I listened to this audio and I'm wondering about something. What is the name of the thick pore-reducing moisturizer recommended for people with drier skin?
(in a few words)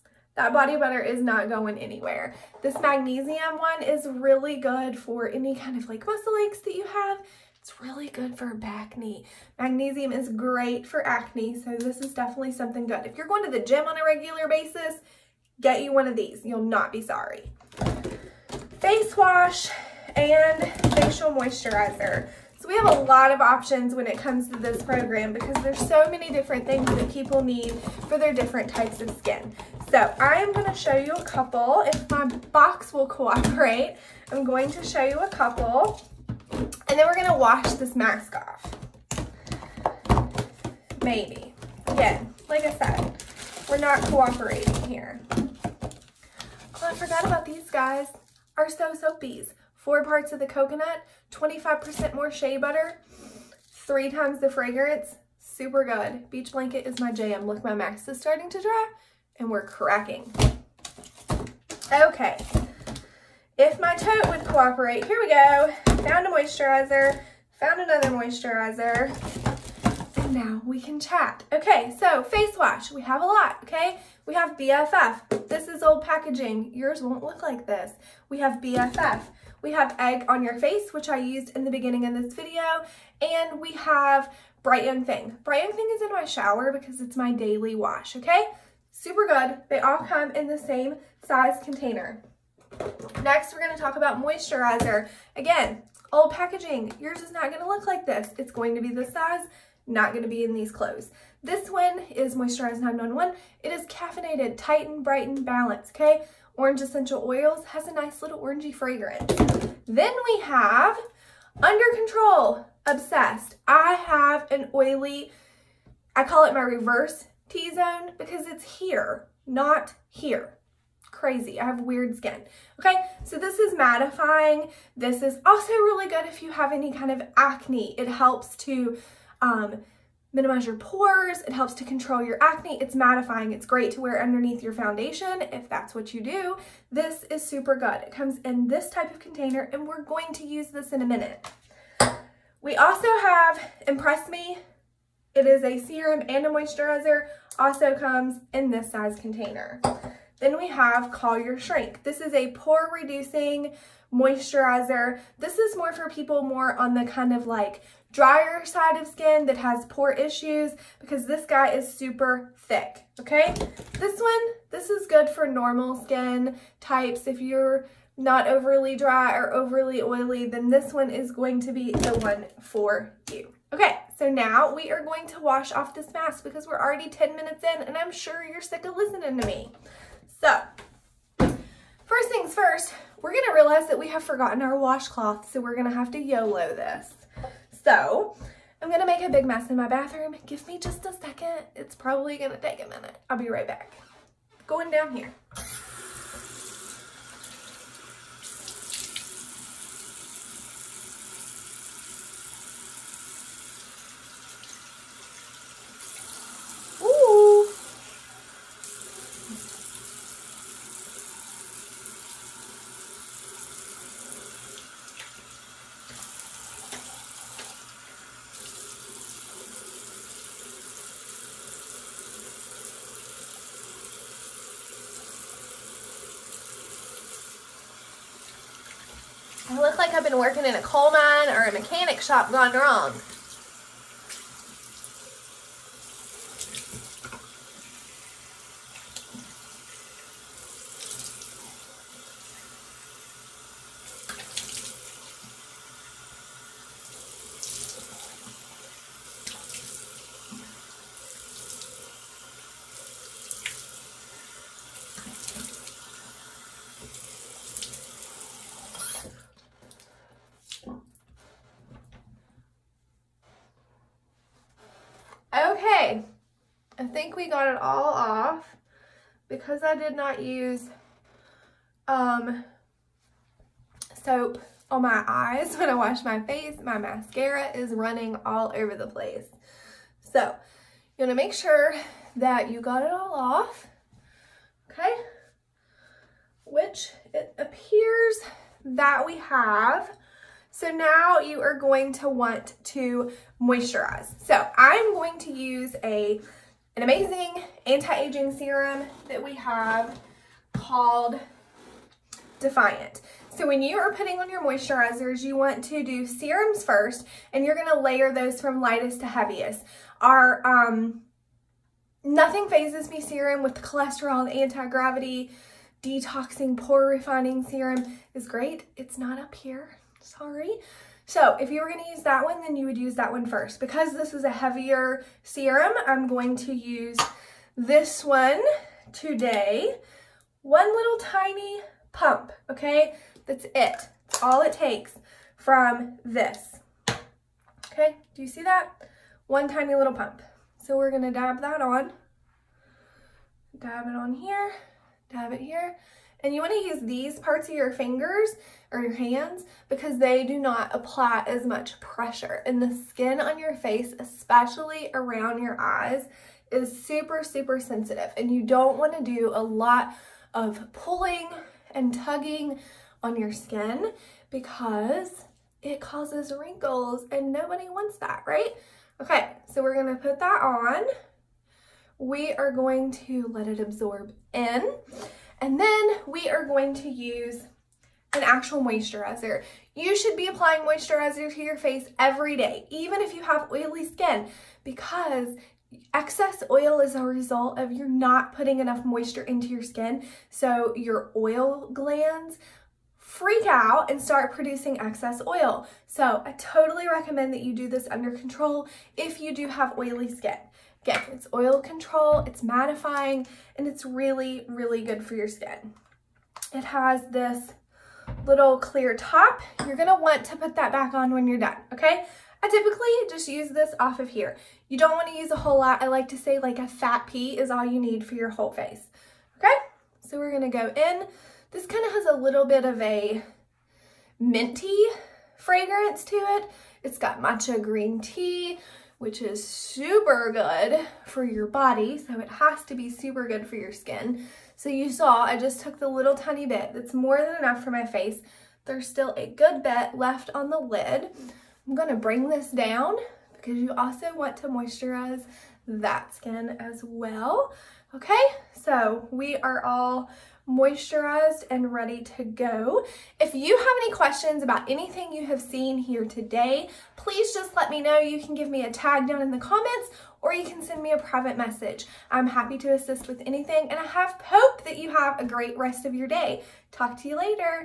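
Call Your Shrink.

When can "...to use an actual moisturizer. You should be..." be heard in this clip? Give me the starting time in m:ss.
6:16.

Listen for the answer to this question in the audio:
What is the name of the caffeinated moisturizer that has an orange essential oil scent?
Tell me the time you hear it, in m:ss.
1:42.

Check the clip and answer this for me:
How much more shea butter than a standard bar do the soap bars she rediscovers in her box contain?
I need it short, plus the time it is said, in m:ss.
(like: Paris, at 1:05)
25%, at 0:51.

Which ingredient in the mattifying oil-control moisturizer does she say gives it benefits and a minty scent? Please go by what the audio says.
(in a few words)
matcha green tea.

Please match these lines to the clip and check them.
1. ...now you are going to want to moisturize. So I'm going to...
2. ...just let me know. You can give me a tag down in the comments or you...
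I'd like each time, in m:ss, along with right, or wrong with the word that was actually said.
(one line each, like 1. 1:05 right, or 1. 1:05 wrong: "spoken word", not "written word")
1. 4:50 right
2. 7:37 right.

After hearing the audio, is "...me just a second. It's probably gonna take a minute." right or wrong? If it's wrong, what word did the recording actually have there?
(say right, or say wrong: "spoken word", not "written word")
right.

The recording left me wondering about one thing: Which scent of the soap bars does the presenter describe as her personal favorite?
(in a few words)
Beach Blanket.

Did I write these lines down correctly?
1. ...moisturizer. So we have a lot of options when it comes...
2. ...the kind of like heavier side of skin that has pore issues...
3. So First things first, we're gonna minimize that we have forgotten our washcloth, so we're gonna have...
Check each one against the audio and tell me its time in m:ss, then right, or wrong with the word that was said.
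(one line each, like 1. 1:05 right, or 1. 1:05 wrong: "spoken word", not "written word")
1. 0:21 right
2. 2:36 wrong: "drier", not "heavier"
3. 3:00 wrong: "realize", not "minimize".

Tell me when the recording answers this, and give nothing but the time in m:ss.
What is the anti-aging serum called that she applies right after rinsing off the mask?
5:02.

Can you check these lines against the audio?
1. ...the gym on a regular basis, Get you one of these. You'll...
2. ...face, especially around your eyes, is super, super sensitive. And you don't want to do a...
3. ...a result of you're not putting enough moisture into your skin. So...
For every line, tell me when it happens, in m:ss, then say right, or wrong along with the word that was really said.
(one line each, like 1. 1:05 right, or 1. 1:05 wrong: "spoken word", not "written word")
1. 0:13 right
2. 5:53 right
3. 6:27 right.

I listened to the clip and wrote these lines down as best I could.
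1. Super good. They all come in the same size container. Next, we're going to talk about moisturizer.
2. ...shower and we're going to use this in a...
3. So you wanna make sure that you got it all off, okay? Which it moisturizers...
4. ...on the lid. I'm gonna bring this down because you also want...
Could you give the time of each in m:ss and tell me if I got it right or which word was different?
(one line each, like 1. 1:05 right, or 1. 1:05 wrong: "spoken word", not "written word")
1. 1:28 right
2. 2:19 wrong: "container", not "shower"
3. 4:40 wrong: "appears", not "moisturizers"
4. 7:20 right.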